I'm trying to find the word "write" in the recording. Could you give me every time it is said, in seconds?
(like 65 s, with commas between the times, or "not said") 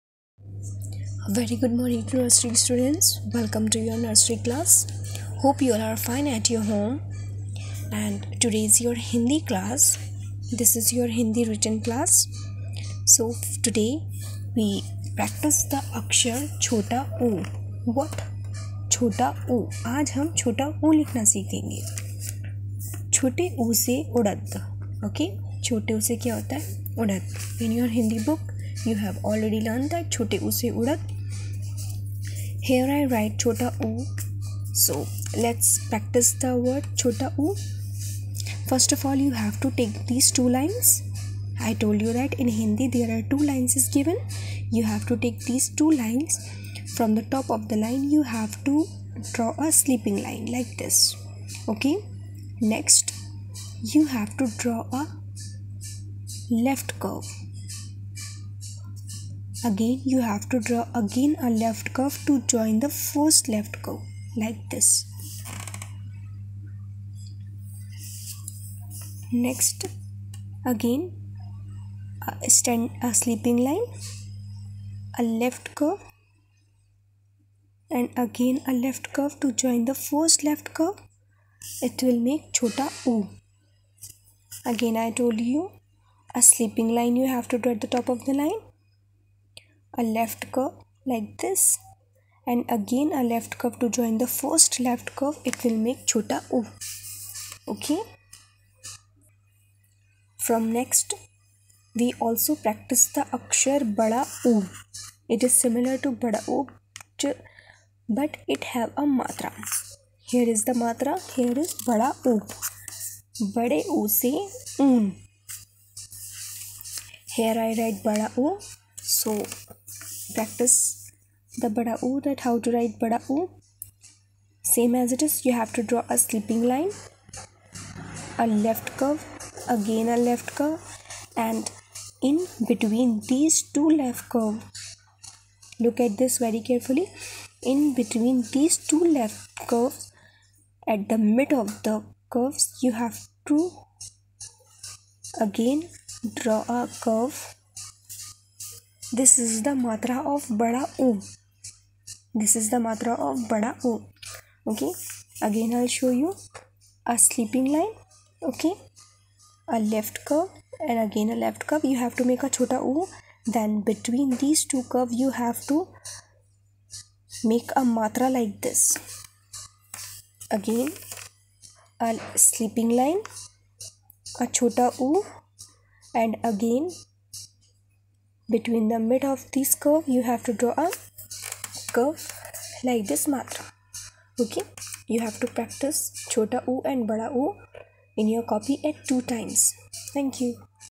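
33 s, 117 s, 122 s.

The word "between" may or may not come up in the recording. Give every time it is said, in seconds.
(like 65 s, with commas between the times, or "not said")
132 s, 138 s, 178 s.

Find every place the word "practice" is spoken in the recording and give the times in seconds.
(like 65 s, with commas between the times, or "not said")
35 s, 102 s, 120 s, 185 s.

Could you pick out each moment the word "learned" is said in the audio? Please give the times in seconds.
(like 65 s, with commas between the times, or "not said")
29 s.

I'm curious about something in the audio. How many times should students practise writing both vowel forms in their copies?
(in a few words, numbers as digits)
2.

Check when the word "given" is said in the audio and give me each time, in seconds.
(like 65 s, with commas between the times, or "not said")
43 s.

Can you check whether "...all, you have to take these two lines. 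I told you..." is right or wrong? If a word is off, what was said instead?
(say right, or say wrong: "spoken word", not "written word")
right.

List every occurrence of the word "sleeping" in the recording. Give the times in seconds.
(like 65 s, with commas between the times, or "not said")
49 s, 73 s, 86 s, 126 s.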